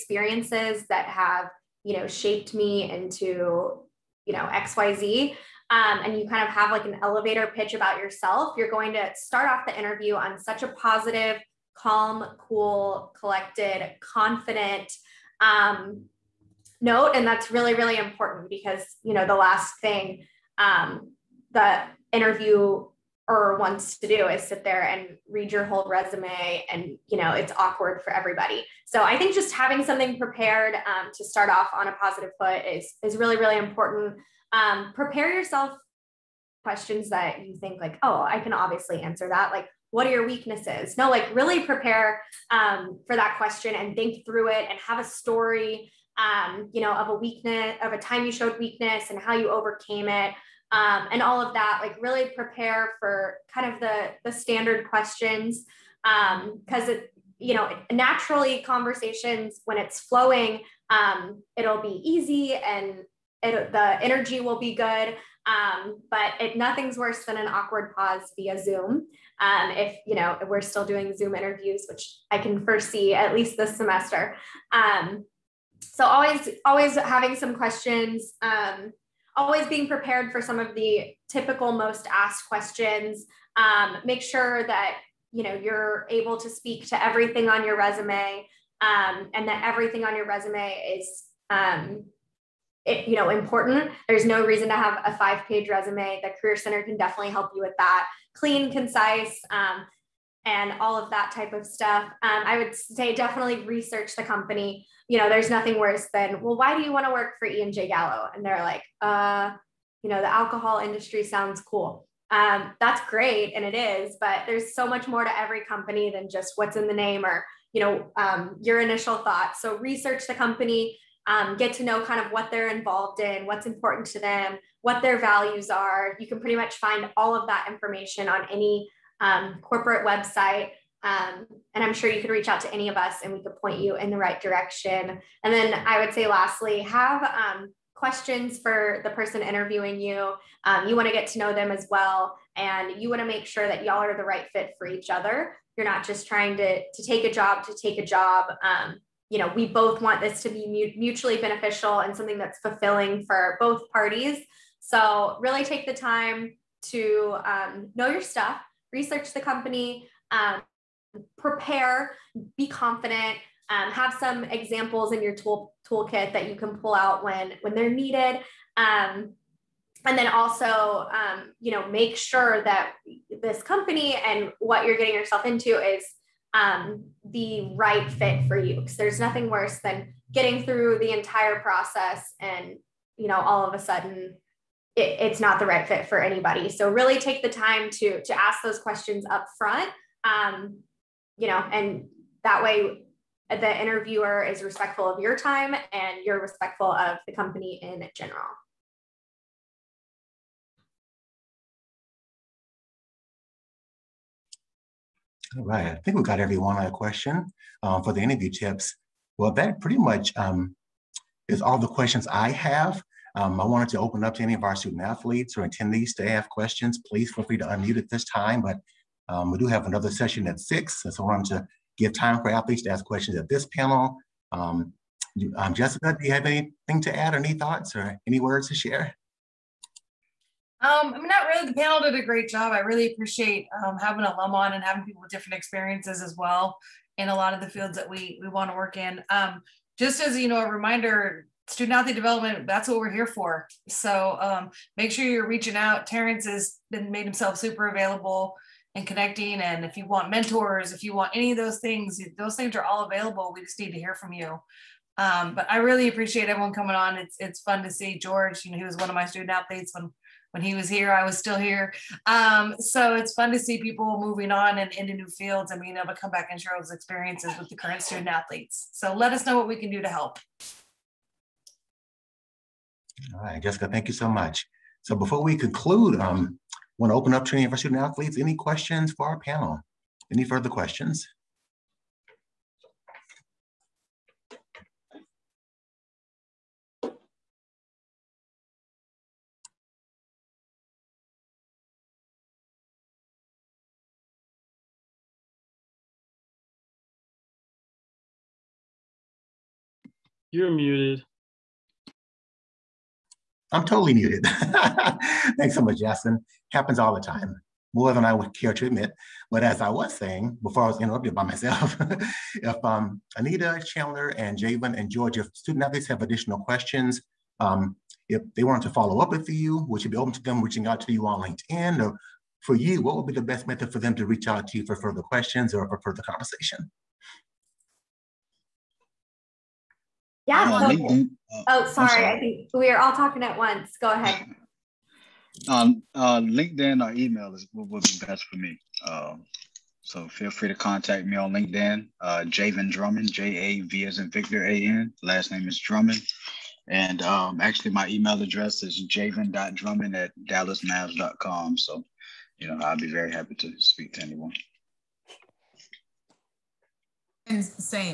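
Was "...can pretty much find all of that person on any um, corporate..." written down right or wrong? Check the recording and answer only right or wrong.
wrong.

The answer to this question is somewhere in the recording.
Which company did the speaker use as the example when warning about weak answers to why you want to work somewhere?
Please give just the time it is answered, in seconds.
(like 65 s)
107 s.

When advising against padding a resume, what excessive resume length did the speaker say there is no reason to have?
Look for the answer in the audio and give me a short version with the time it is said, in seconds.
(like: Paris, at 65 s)
5 pages, at 95 s.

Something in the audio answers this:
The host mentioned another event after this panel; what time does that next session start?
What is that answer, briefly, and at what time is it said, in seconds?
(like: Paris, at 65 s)
6, at 220 s.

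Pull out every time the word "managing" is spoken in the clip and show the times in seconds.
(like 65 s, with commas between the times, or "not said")
not said.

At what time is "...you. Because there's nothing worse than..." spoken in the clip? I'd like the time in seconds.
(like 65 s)
178 s.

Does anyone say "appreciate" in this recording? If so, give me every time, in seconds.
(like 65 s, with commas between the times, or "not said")
233 s, 256 s.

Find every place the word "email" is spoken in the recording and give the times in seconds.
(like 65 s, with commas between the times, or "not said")
337 s, 348 s.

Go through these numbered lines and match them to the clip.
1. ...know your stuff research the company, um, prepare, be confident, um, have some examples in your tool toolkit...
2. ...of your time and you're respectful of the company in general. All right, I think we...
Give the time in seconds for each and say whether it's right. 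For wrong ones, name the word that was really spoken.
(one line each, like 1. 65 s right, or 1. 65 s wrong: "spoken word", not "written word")
1. 157 s right
2. 195 s right.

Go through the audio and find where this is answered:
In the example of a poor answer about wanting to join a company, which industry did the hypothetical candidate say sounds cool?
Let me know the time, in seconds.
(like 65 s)
110 s.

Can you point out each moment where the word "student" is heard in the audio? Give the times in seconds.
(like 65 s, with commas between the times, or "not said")
214 s, 241 s, 259 s, 268 s, 277 s, 315 s.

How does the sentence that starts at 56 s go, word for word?
Um, Cause it, you know, naturally conversations when it's flowing, um, it'll be easy and it, the energy will be good.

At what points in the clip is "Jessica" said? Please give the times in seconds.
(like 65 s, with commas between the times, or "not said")
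225 s, 273 s.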